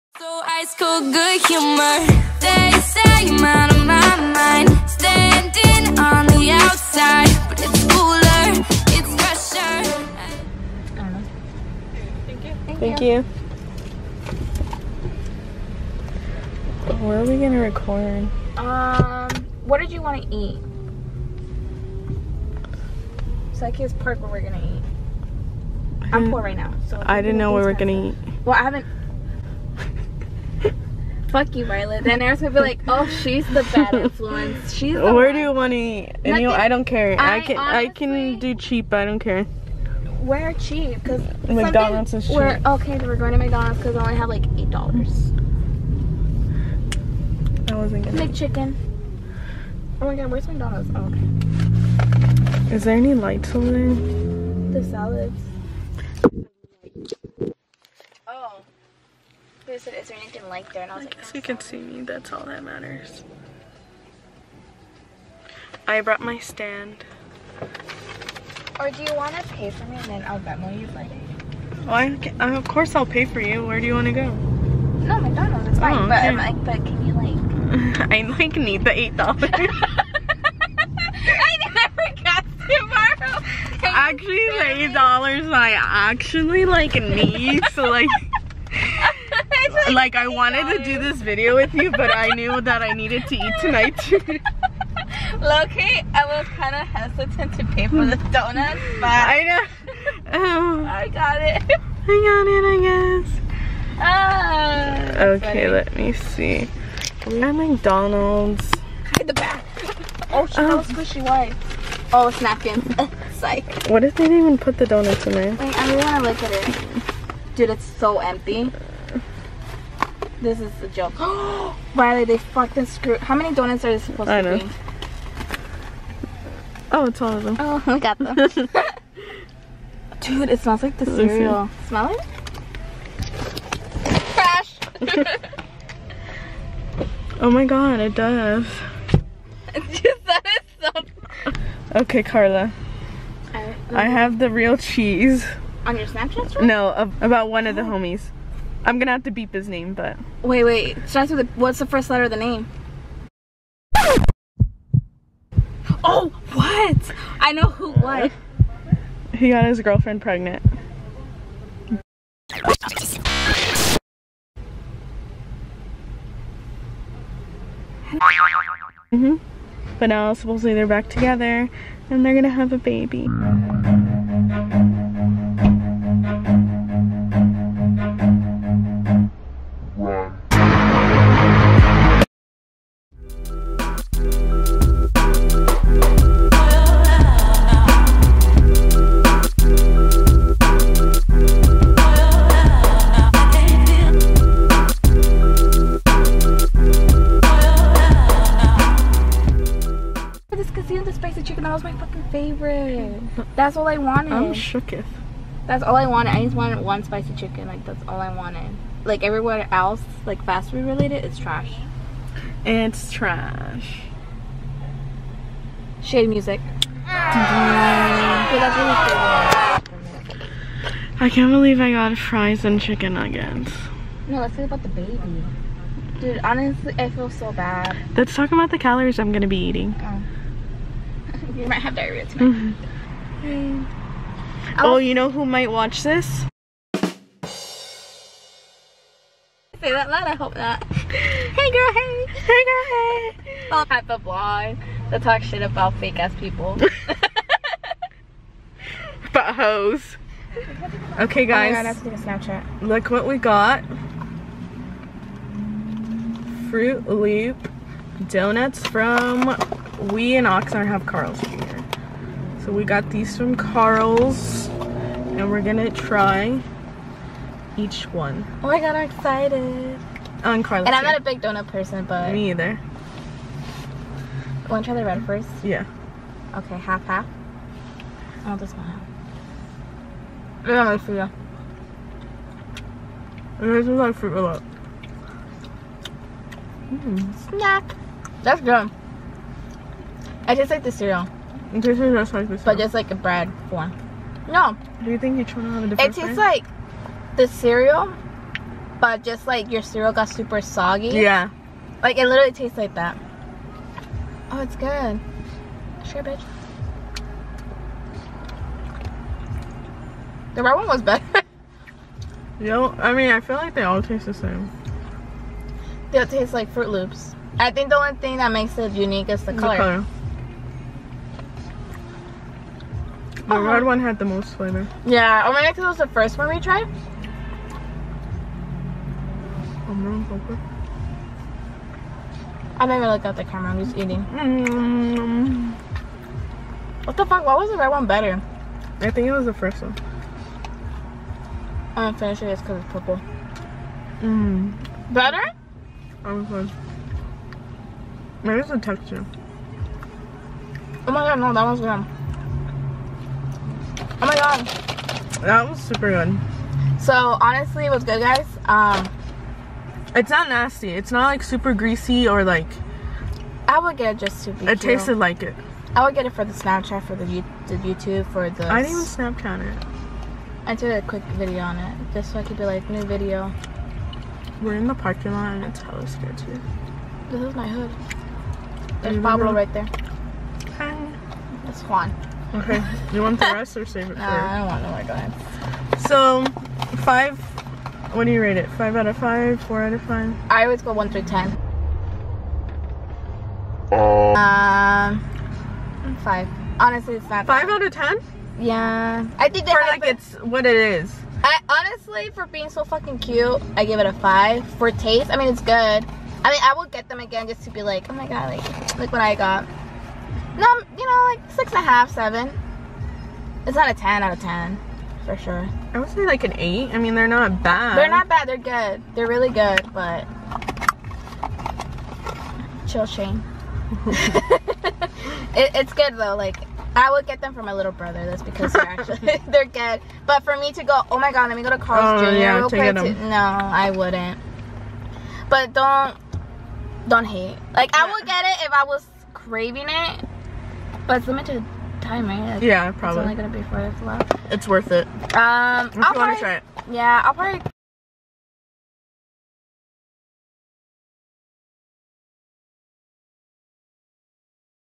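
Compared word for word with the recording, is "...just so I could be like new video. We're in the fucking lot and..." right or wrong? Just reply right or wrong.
wrong.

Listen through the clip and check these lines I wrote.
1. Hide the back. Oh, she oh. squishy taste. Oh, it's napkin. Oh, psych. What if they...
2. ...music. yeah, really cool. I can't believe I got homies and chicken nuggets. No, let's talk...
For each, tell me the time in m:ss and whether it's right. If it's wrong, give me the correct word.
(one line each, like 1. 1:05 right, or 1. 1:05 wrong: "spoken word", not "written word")
1. 1:49 wrong: "white", not "taste"
2. 3:36 wrong: "fries", not "homies".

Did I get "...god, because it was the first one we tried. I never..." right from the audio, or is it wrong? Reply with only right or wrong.
right.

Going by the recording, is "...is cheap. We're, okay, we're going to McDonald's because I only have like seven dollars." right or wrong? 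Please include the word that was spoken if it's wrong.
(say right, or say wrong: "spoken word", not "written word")
wrong: "eight", not "seven".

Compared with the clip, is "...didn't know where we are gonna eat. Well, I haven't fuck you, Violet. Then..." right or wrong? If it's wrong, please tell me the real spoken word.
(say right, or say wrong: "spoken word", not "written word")
right.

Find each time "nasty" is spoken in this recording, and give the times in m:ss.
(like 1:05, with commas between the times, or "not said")
6:00.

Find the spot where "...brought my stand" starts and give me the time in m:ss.
1:06.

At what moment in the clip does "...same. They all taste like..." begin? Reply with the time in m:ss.
5:14.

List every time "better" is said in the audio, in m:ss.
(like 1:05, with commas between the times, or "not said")
5:11, 5:38, 5:45.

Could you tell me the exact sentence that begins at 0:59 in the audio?
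said, is there anything like there?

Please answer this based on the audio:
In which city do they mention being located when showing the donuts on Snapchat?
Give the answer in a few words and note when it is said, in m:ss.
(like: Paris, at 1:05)
Oxnard, at 4:20.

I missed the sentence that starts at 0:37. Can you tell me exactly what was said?
I, I can honestly, I can do cheap.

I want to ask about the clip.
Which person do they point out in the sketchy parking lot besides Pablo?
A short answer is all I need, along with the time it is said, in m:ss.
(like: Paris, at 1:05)
Juan, at 6:21.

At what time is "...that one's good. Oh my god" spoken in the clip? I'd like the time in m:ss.
5:51.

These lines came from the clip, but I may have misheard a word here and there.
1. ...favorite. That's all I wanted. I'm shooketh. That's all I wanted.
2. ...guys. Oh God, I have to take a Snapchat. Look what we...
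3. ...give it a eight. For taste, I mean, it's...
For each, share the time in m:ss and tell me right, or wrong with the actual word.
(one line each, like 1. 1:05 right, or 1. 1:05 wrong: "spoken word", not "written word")
1. 3:22 right
2. 4:11 right
3. 6:43 wrong: "five", not "eight".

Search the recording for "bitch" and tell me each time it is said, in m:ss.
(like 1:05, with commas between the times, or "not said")
5:06.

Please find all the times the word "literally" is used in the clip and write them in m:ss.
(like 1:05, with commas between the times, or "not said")
5:02.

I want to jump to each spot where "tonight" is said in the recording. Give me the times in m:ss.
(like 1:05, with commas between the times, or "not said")
1:33, 3:52.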